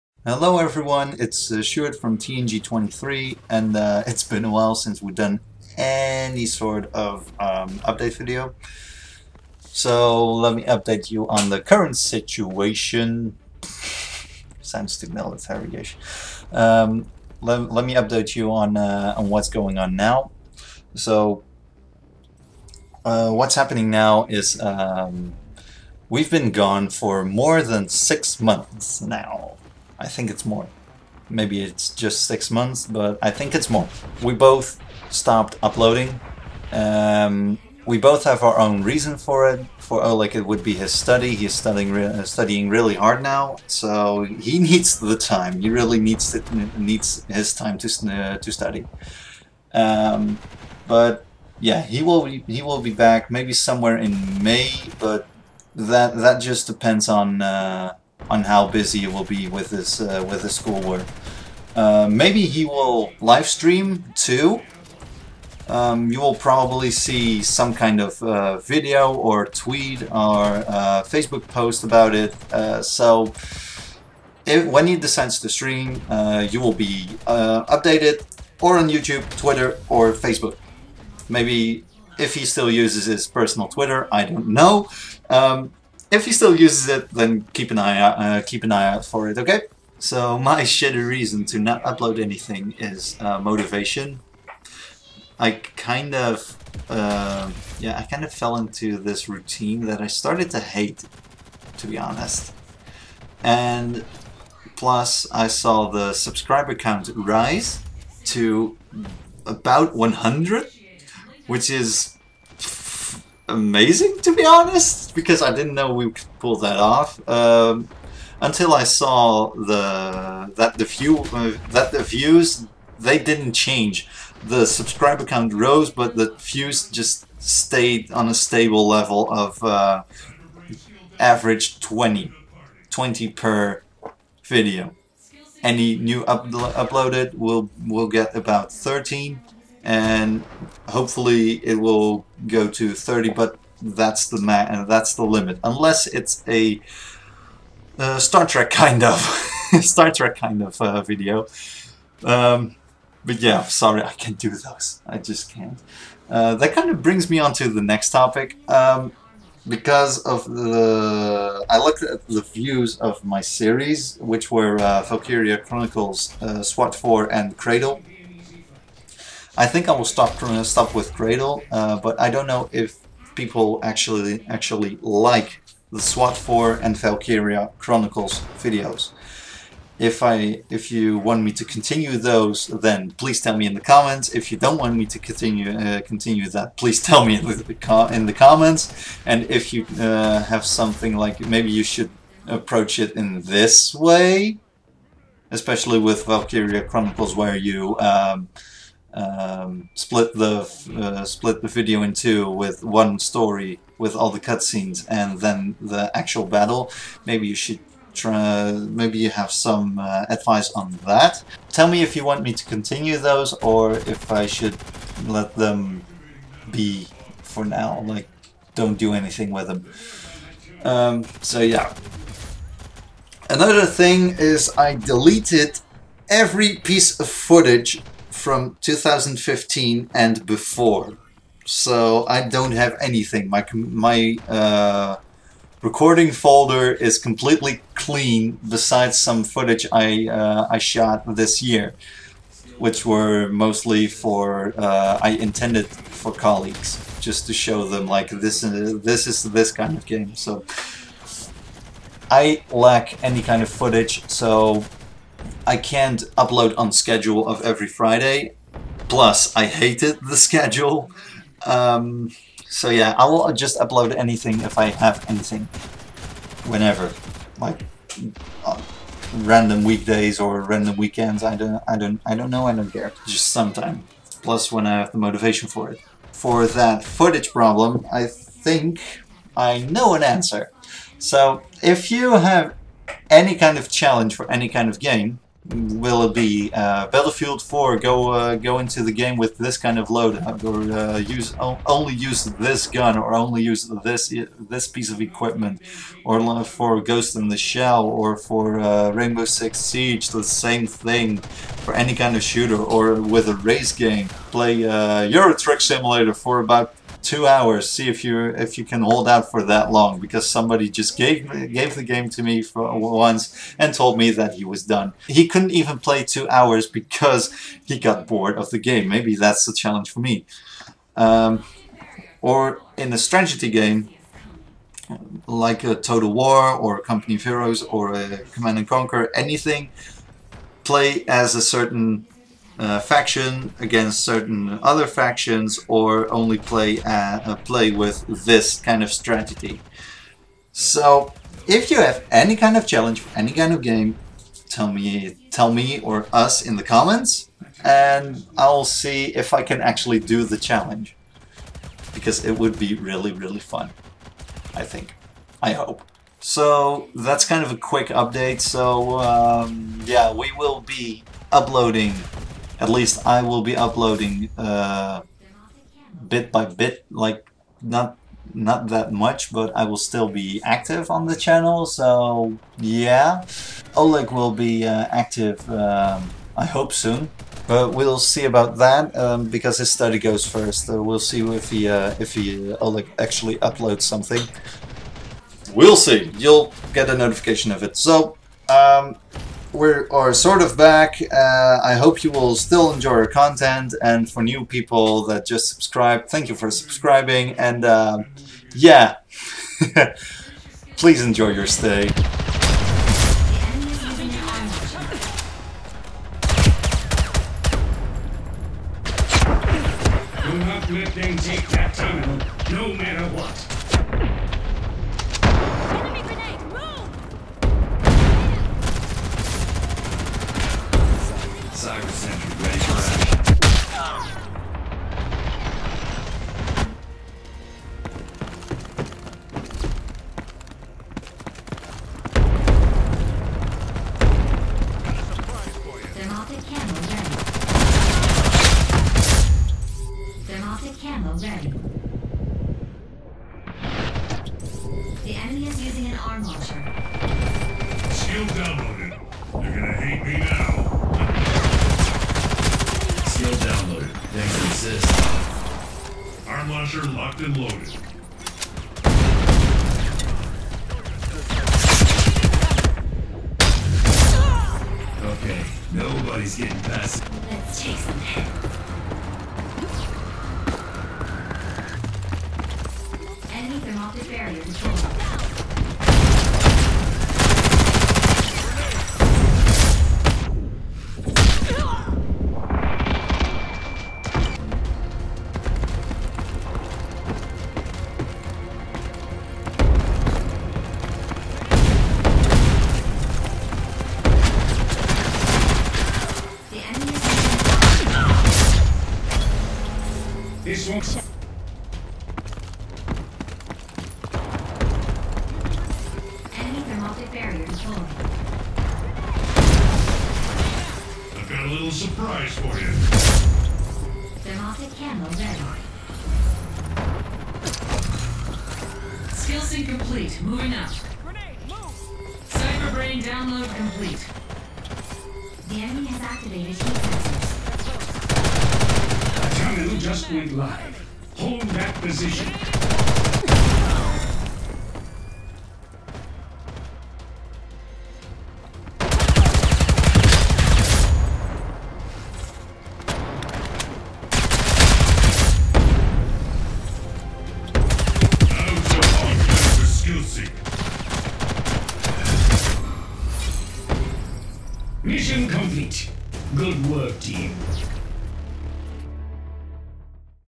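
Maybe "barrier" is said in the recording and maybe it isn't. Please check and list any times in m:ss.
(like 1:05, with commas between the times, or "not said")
7:54, 8:27.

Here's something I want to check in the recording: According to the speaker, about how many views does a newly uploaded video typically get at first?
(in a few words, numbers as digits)
13.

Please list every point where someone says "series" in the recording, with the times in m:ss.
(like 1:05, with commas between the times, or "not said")
2:43.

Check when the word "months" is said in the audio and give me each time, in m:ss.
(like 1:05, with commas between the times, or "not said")
0:28, 0:32.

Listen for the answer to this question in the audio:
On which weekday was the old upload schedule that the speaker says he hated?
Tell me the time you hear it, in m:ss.
4:17.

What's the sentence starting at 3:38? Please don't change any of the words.
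Like, don't do anything with them.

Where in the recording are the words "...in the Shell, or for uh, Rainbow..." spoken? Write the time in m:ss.
4:57.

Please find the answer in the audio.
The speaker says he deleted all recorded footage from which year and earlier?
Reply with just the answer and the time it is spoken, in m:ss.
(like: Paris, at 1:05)
2015, at 3:48.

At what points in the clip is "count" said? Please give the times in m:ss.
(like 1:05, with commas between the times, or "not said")
1:46, 2:05.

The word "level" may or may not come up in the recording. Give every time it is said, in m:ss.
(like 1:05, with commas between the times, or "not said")
2:08.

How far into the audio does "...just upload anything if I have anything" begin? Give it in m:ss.
4:23.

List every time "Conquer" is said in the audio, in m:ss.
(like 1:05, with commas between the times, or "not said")
5:28.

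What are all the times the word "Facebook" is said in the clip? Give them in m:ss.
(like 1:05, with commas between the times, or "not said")
1:11, 1:20.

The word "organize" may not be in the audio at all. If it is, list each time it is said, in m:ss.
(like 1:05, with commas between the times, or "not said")
not said.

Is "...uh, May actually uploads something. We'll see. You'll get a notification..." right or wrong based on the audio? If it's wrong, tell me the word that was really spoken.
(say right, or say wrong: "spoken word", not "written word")
wrong: "Oleg", not "May".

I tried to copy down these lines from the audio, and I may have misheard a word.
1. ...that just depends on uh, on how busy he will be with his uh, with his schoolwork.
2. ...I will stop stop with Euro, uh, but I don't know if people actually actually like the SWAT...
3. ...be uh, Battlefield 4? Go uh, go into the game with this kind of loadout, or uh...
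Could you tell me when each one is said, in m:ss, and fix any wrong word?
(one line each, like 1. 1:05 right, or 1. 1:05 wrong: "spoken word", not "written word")
1. 0:56 right
2. 2:49 wrong: "Cradle", not "Euro"
3. 4:46 right.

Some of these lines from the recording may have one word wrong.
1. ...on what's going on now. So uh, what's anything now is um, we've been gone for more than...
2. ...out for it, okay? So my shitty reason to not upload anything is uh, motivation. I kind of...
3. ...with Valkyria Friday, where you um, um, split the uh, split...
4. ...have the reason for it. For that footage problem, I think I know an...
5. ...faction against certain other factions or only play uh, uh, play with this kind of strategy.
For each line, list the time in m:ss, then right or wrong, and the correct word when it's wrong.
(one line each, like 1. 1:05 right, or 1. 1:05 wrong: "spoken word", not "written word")
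1. 0:19 wrong: "happening", not "anything"
2. 1:28 right
3. 3:15 wrong: "Chronicles", not "Friday"
4. 4:34 wrong: "motivation", not "reason"
5. 5:32 right.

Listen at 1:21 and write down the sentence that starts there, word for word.
Maybe if he still uses his personal Twitter, I don't know.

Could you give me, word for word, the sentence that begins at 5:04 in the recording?
Play uh, Euro Truck Simulator for about two hours.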